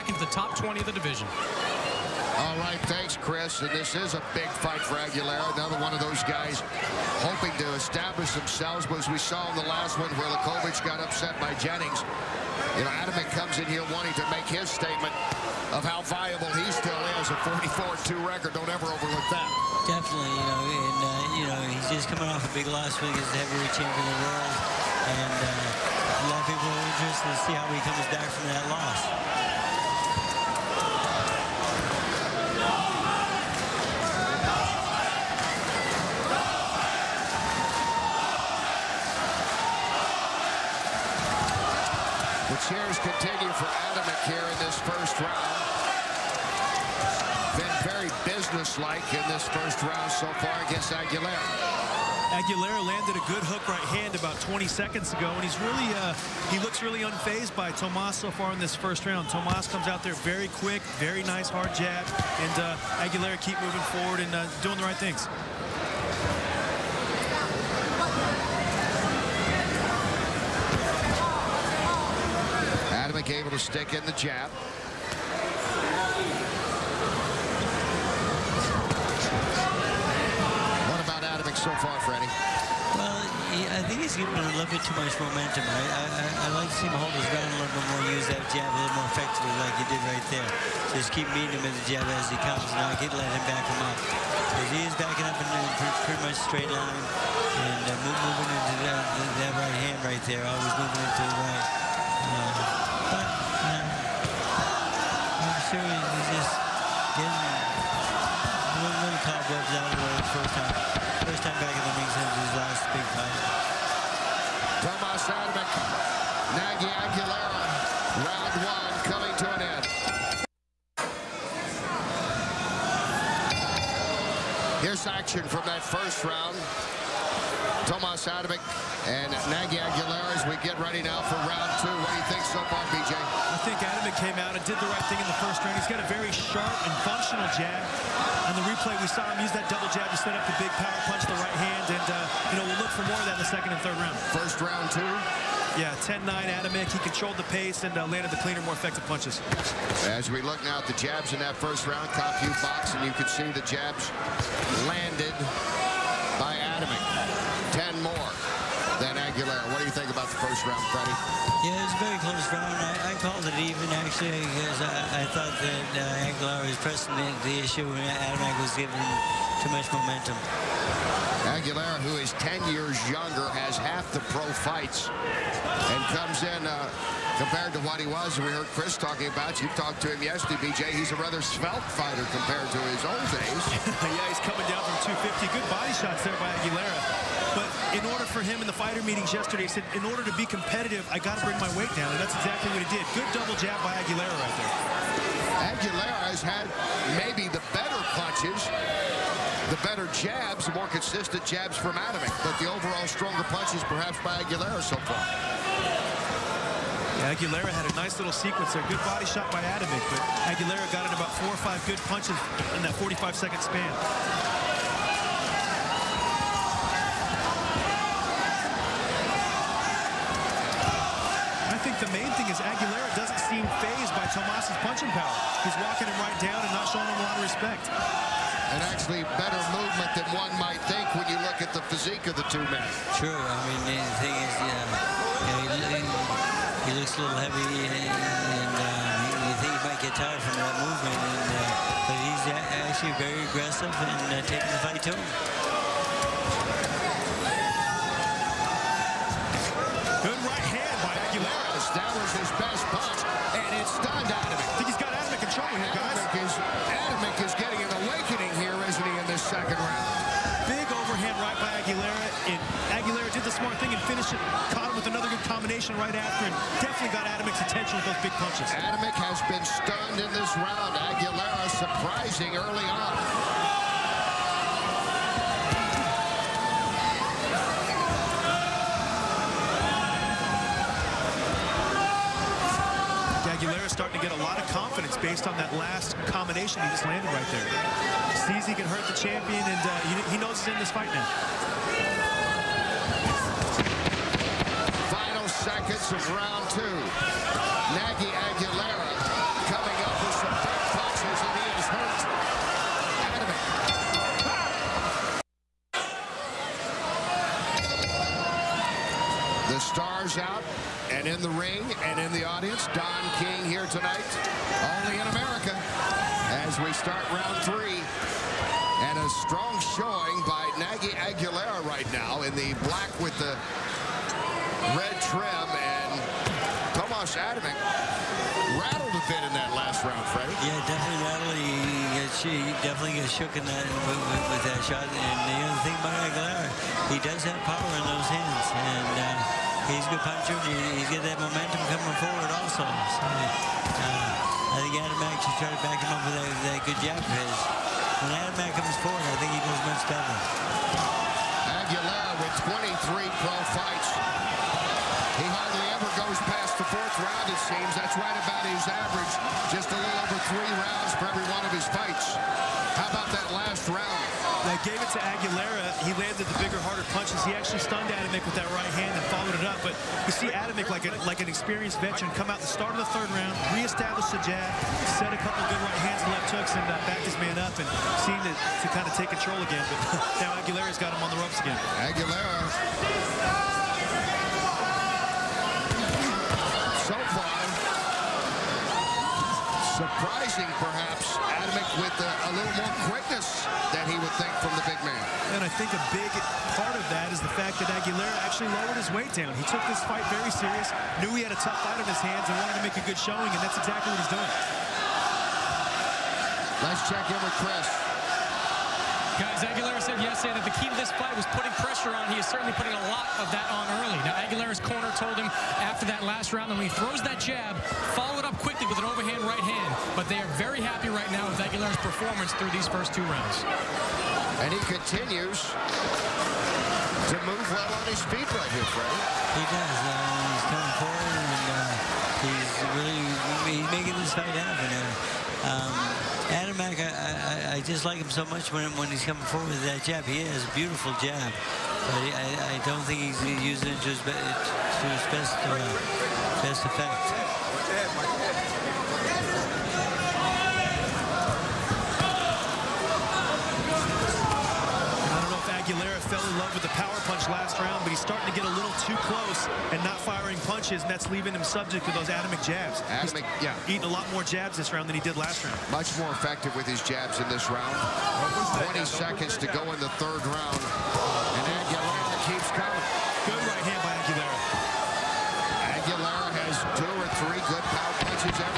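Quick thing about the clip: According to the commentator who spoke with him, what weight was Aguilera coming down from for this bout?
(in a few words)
250.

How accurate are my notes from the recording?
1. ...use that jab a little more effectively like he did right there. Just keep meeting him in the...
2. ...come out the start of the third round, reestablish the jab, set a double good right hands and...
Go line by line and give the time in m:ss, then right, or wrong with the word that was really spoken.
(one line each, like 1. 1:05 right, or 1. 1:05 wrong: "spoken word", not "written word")
1. 1:28 right
2. 6:12 wrong: "couple", not "double".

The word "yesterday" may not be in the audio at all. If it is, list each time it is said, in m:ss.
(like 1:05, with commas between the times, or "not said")
3:00, 3:09, 6:50.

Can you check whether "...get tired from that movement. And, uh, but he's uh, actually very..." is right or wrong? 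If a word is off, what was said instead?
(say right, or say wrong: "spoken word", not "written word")
right.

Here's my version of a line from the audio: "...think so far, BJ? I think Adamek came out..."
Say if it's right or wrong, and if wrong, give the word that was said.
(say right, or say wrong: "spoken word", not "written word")
right.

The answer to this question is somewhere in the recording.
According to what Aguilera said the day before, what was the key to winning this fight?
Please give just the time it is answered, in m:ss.
6:51.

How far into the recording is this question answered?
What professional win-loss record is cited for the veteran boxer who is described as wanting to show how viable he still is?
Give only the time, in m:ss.
0:17.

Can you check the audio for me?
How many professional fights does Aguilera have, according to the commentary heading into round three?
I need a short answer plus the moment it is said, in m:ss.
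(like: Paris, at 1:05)
23, at 5:53.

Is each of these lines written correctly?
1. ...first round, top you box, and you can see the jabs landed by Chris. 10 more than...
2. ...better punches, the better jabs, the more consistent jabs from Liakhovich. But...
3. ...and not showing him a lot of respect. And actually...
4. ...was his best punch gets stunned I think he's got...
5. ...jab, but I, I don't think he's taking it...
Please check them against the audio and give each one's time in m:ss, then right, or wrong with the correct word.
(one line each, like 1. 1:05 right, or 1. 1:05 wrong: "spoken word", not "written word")
1. 2:31 wrong: "Adamek", not "Chris"
2. 3:17 wrong: "Adamek", not "Liakhovich"
3. 3:46 right
4. 4:12 right
5. 7:21 wrong: "using", not "taking".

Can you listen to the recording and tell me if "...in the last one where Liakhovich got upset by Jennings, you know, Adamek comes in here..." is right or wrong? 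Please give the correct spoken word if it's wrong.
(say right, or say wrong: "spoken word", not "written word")
right.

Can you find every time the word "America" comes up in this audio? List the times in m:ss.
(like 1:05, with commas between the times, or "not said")
5:15.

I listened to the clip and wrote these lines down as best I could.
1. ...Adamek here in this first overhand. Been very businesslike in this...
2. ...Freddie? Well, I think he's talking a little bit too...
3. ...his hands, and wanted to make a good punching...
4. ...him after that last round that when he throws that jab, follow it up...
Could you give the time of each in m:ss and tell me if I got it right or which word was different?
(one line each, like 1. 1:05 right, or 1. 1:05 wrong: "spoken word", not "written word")
1. 0:43 wrong: "round", not "overhand"
2. 1:22 wrong: "giving", not "talking"
3. 6:42 wrong: "showing", not "punching"
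4. 6:55 right.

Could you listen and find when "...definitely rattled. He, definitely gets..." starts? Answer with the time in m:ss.
5:30.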